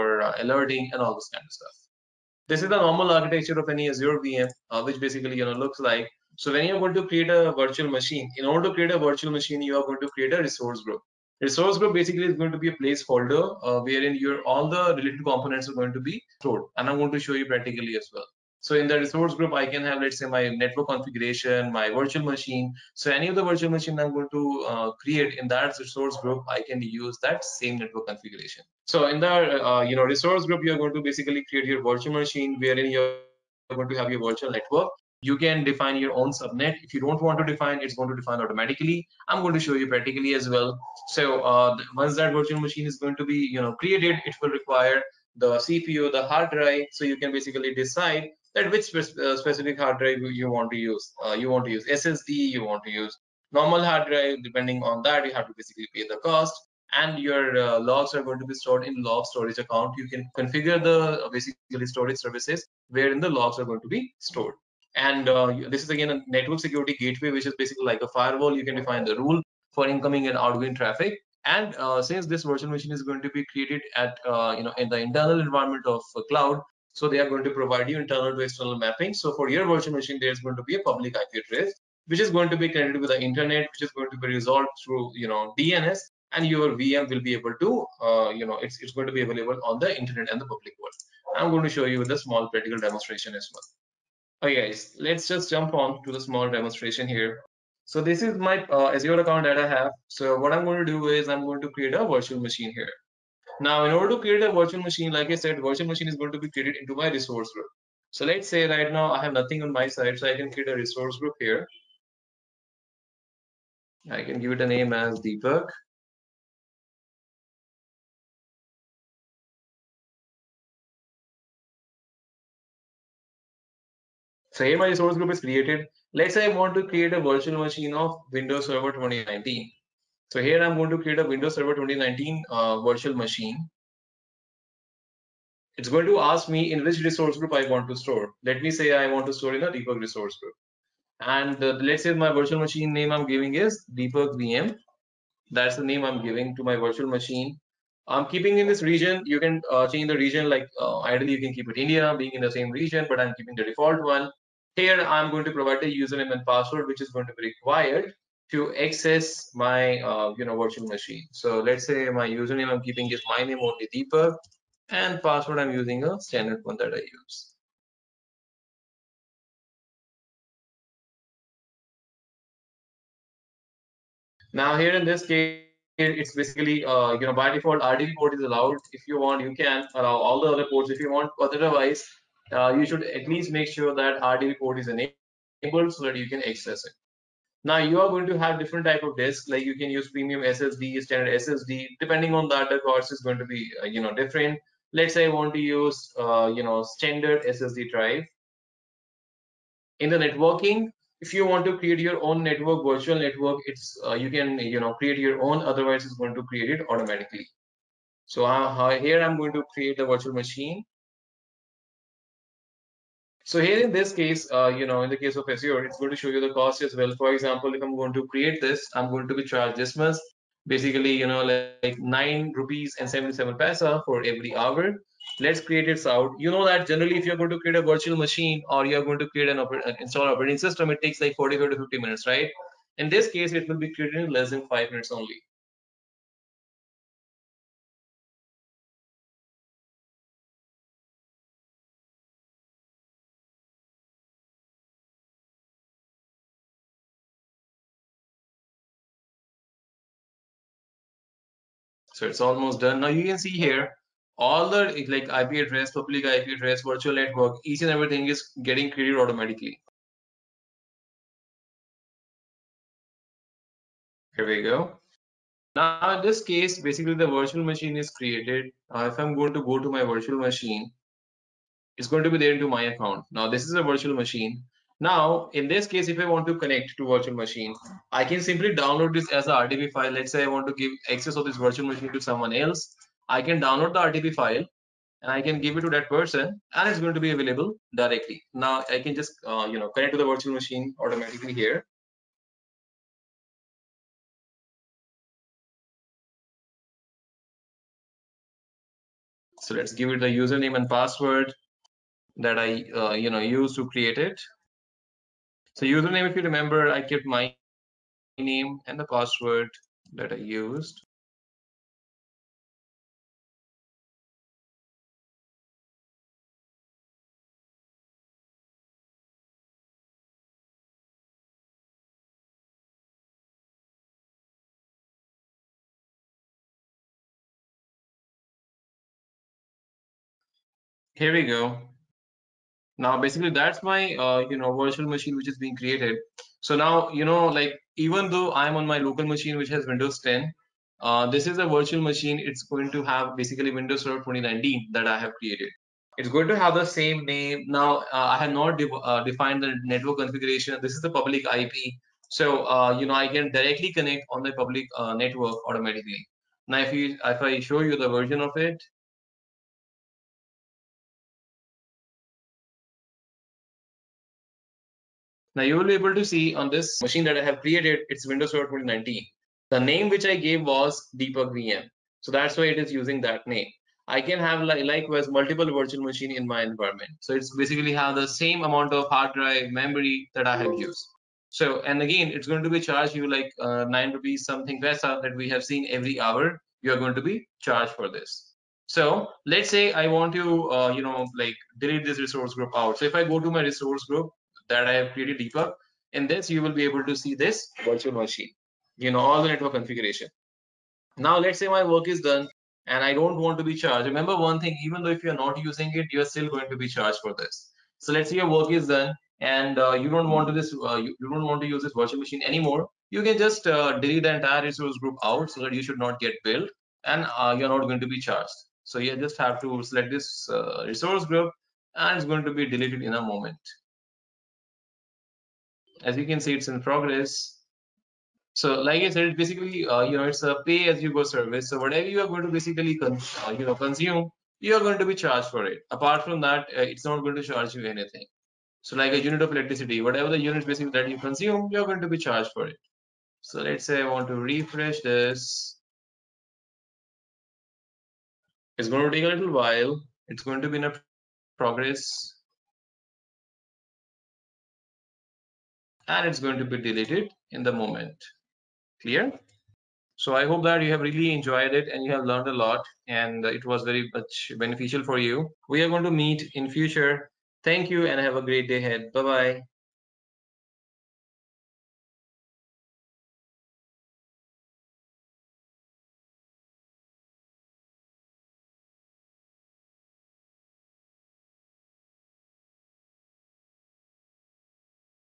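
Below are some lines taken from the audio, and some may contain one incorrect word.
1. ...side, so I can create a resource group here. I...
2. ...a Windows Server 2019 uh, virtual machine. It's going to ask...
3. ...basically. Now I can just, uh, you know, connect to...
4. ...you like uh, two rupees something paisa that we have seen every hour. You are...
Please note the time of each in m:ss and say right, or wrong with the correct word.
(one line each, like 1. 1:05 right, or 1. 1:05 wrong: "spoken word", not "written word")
1. 1:49 right
2. 2:11 right
3. 4:47 wrong: "directly", not "basically"
4. 6:23 wrong: "nine", not "two".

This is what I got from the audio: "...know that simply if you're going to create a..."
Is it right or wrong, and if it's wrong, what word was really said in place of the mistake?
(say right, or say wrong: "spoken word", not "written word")
wrong: "generally", not "simply".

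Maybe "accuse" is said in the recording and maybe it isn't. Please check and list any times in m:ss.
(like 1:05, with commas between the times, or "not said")
not said.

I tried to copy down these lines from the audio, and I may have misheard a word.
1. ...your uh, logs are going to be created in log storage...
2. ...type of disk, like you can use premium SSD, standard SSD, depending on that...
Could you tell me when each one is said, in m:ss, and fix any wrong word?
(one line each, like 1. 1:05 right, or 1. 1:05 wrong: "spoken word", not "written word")
1. 0:57 wrong: "stored", not "created"
2. 3:08 right.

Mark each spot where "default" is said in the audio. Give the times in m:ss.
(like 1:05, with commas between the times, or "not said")
2:33, 2:57.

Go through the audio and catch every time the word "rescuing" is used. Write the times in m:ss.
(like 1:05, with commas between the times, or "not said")
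not said.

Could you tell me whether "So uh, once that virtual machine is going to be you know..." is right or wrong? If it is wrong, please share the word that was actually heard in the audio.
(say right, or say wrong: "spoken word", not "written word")
right.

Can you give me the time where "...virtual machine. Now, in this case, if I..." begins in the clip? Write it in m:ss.
4:33.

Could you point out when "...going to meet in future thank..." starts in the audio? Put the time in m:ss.
7:45.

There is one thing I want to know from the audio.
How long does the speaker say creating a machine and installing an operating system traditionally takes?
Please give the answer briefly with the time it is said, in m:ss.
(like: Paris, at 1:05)
45 to 50 minutes, at 3:51.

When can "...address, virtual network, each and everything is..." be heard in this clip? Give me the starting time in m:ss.
4:16.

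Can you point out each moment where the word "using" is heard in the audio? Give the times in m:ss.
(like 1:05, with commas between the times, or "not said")
2:45, 6:12, 6:45.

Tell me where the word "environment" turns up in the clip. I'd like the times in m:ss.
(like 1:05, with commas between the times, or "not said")
1:15, 6:16.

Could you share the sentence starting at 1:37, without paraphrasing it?
So this is my uh, Azure account that I have.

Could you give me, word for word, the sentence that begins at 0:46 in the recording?
So you can basically decide that which uh, specific hard drive you want to use.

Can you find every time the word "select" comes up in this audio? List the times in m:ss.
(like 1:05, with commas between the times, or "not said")
6:59.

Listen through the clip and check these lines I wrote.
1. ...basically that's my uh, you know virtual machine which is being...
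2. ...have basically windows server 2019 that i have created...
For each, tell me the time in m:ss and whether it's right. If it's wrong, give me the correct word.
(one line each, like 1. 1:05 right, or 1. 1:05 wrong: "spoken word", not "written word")
1. 5:33 right
2. 5:43 right.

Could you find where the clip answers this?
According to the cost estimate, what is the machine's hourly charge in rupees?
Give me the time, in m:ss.
3:41.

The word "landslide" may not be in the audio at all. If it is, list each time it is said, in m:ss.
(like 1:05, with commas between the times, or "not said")
not said.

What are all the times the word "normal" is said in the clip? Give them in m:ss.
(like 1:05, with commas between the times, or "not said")
0:02, 0:53.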